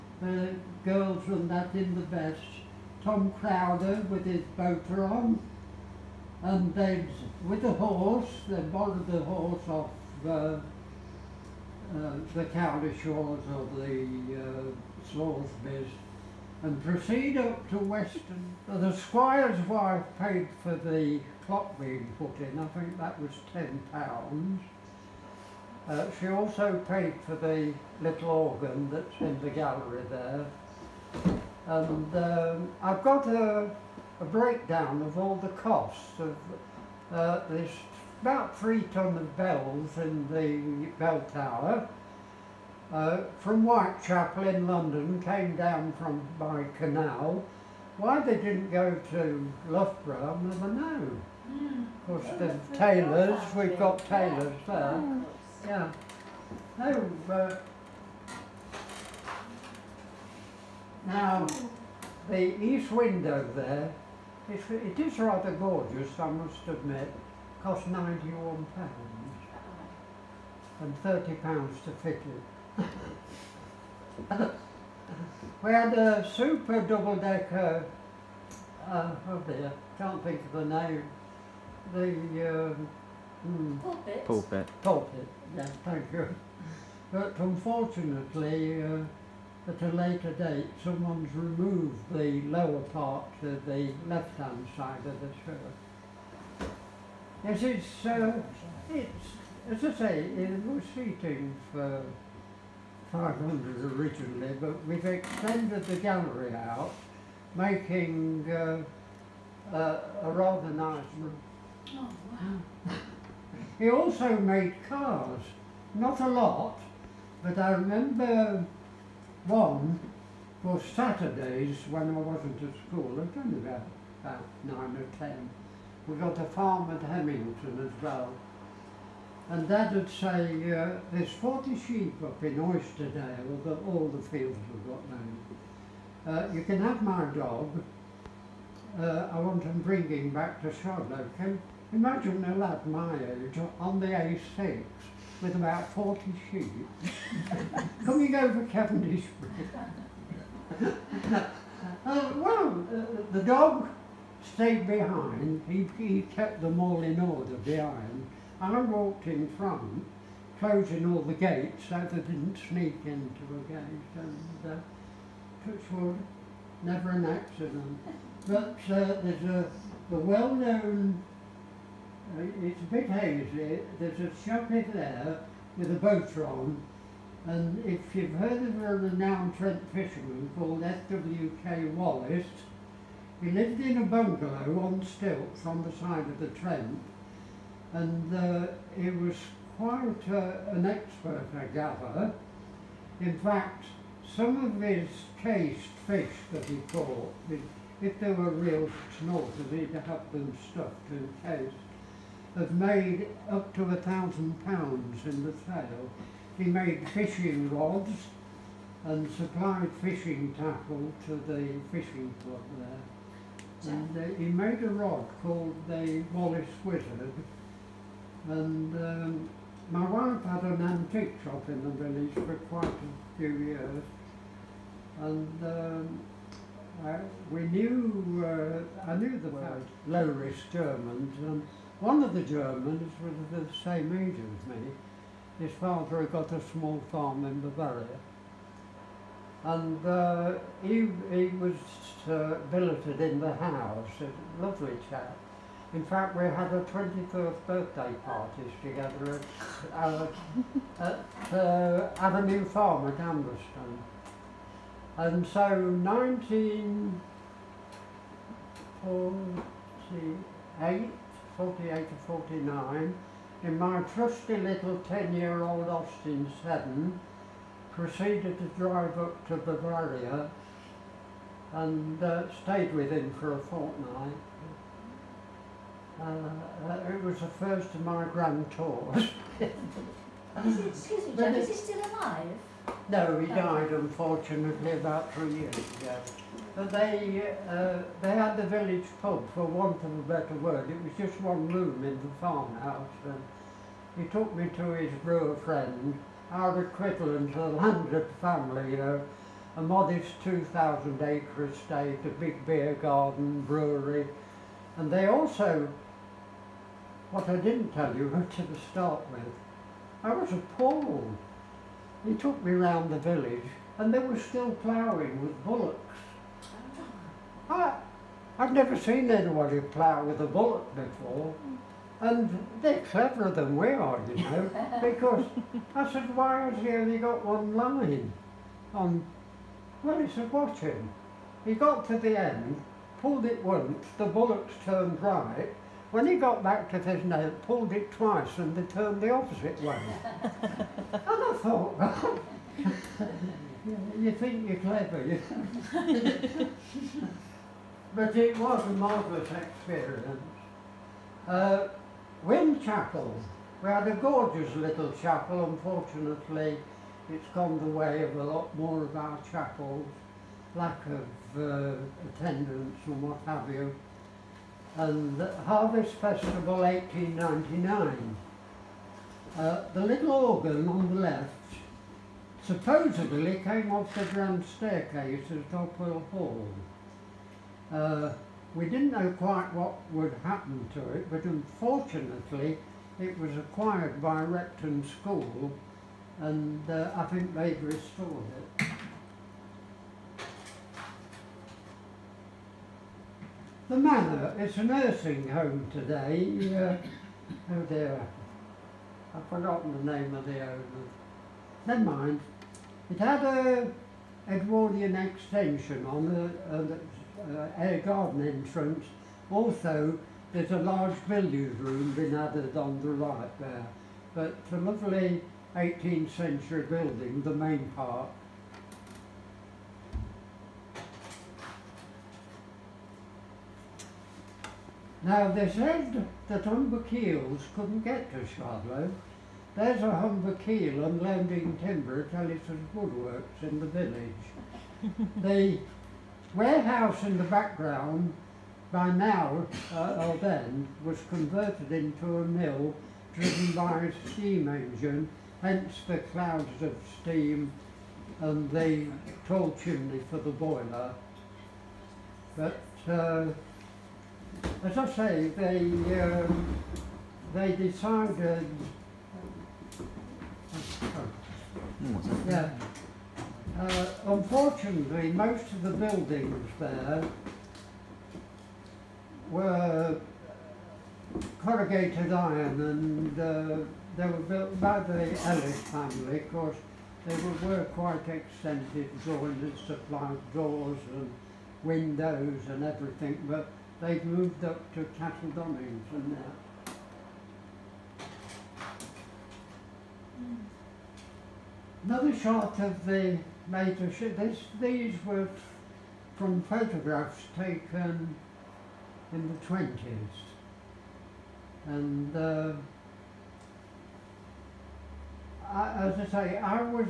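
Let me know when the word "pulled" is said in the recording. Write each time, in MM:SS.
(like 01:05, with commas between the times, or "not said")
05:33, 05:37.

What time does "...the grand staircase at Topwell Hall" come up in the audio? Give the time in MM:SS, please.
06:14.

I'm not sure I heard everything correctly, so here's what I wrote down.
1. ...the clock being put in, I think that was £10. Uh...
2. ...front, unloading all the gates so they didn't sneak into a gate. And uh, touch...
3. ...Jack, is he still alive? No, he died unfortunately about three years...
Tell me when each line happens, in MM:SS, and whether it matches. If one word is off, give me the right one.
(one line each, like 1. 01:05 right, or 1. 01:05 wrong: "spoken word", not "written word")
1. 00:20 right
2. 02:39 wrong: "closing", not "unloading"
3. 04:41 right.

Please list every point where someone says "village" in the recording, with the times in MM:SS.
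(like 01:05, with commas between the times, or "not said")
03:41, 04:48, 05:13, 07:13.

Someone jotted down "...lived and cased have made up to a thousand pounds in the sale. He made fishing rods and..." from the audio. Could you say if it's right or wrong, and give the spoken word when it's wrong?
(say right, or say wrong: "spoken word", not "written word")
wrong: "stuffed", not "lived".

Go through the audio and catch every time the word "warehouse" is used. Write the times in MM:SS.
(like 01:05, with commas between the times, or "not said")
07:16.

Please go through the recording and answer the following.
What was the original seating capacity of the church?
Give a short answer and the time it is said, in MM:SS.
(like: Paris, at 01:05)
500, at 01:43.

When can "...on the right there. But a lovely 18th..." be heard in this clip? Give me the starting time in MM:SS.
06:52.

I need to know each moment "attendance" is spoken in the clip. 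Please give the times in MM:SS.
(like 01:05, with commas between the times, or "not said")
06:02.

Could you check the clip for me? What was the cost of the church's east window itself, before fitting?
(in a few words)
£91.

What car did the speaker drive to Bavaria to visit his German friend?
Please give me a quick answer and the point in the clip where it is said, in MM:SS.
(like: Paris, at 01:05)
Austin 7, at 04:25.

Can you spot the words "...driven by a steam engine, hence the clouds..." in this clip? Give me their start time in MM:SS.
07:23.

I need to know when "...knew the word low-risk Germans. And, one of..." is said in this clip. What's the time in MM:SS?
03:49.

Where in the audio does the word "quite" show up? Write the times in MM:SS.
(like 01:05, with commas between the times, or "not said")
03:09, 03:42, 06:19, 07:57.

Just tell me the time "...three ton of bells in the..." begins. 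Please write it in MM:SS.
00:38.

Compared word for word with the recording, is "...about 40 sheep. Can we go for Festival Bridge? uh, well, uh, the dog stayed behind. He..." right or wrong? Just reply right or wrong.
wrong.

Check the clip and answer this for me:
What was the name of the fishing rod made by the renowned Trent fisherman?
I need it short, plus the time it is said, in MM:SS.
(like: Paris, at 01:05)
Wallace Wizard, at 03:35.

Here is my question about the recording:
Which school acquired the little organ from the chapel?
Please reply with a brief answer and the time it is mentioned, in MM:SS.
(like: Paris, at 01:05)
Repton School, at 06:24.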